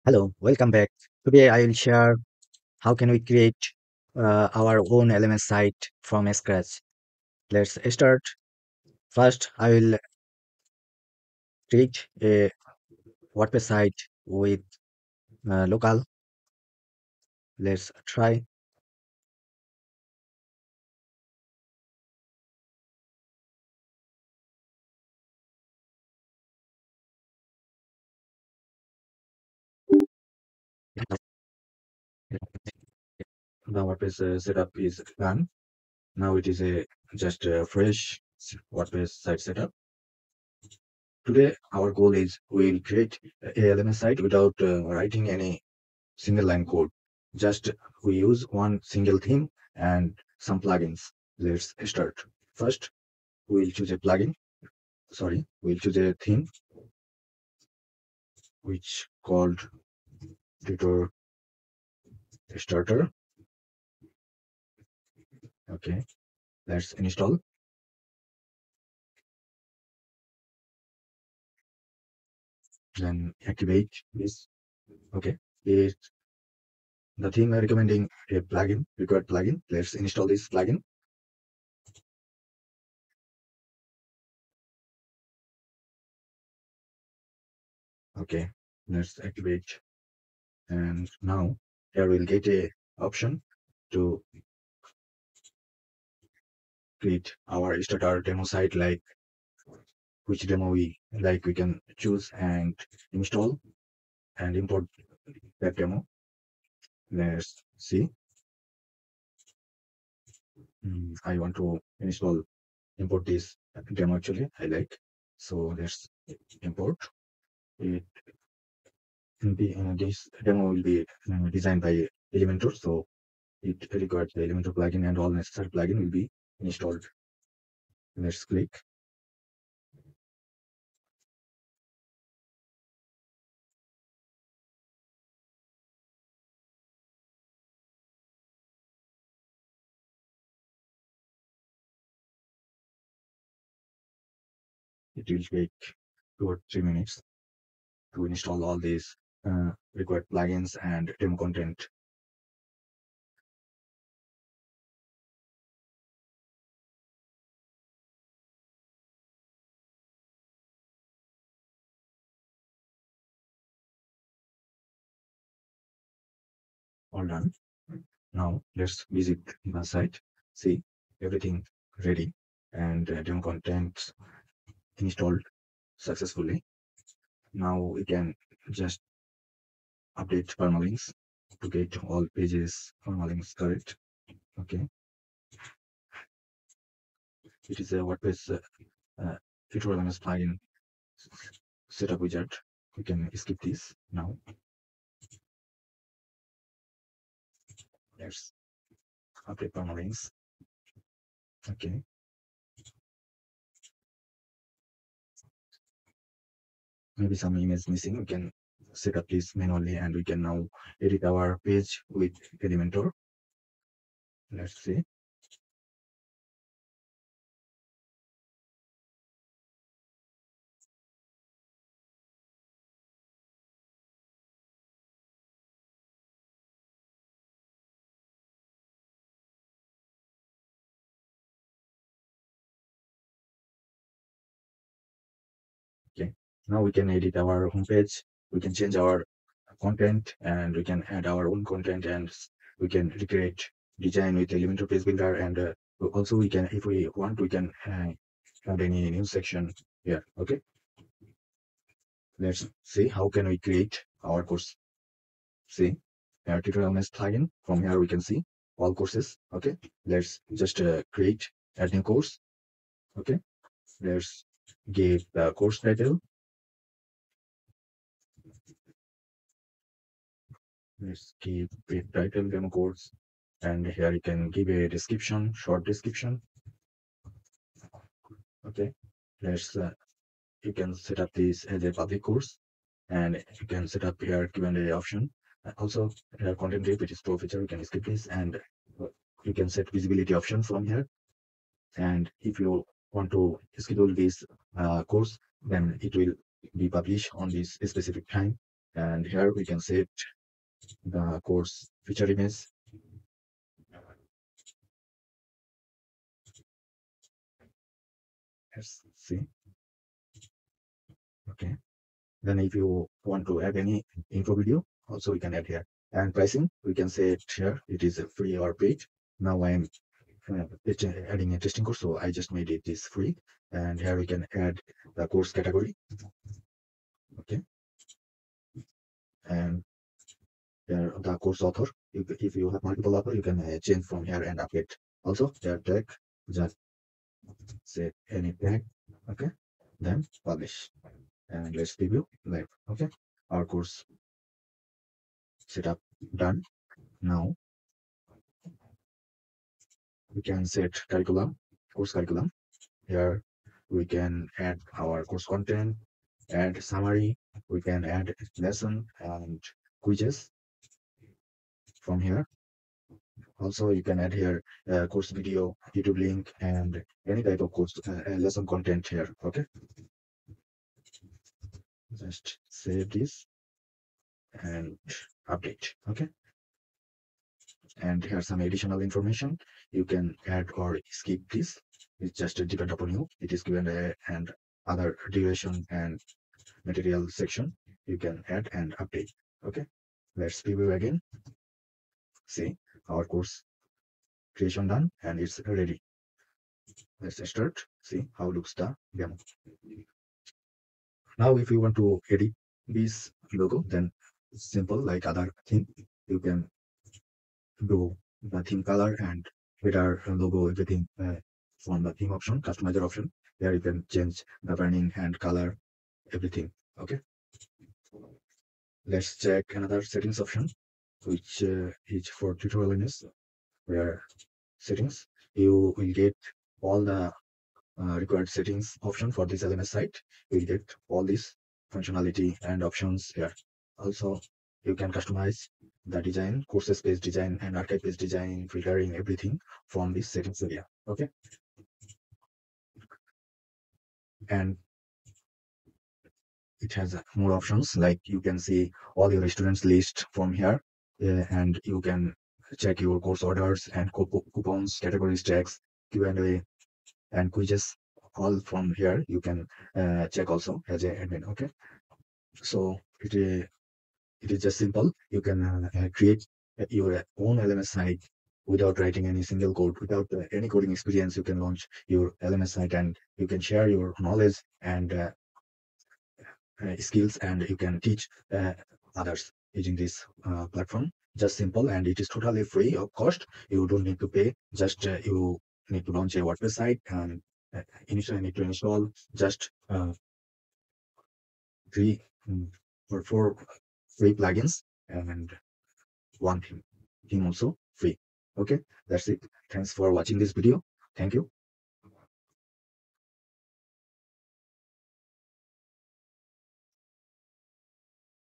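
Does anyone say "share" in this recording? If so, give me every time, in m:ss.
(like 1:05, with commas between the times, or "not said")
0:01, 7:53.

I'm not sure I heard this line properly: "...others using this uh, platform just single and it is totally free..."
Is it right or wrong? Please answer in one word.
wrong.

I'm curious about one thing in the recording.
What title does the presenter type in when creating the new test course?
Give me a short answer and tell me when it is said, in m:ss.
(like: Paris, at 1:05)
demo course, at 4:32.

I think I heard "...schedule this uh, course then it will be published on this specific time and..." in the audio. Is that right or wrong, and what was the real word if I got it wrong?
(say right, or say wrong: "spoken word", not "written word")
right.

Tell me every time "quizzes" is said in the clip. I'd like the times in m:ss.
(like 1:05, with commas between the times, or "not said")
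6:00, 7:37.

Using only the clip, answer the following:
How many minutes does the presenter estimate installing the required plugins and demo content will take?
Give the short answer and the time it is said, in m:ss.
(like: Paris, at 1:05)
2 or 3, at 2:26.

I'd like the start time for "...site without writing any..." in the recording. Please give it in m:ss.
7:47.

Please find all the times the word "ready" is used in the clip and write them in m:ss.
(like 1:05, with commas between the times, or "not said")
2:52, 6:35.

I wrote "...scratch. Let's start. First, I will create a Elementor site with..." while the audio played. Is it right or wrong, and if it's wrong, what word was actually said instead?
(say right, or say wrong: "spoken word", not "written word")
wrong: "WordPress", not "Elementor".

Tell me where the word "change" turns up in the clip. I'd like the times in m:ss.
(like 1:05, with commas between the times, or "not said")
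3:58, 5:33, 6:54.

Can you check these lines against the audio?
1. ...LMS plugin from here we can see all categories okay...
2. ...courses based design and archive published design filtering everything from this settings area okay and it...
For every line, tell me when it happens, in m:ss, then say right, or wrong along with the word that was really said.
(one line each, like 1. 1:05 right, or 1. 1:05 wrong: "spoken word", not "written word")
1. 4:16 wrong: "courses", not "categories"
2. 7:16 wrong: "based", not "published".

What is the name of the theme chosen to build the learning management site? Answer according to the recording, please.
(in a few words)
Tutor Starter.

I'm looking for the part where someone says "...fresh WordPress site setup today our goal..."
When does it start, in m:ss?
0:37.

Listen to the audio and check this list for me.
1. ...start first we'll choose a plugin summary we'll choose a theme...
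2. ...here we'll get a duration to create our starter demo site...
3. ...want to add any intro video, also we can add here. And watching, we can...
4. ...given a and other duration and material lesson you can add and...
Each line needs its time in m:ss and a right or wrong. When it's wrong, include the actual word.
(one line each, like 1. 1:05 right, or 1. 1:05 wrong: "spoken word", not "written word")
1. 0:51 wrong: "sorry", not "summary"
2. 1:31 wrong: "option", not "duration"
3. 5:13 wrong: "pricing", not "watching"
4. 6:23 wrong: "section", not "lesson".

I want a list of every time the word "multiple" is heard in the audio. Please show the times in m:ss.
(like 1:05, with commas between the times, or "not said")
5:32.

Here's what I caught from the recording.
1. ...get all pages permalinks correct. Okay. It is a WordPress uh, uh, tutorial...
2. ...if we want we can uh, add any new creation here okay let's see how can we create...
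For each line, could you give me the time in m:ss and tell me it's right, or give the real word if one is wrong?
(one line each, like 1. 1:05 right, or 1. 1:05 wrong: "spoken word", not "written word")
1. 3:01 right
2. 4:06 wrong: "section", not "creation".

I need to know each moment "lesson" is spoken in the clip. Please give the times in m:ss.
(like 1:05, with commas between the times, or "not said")
5:58, 6:08.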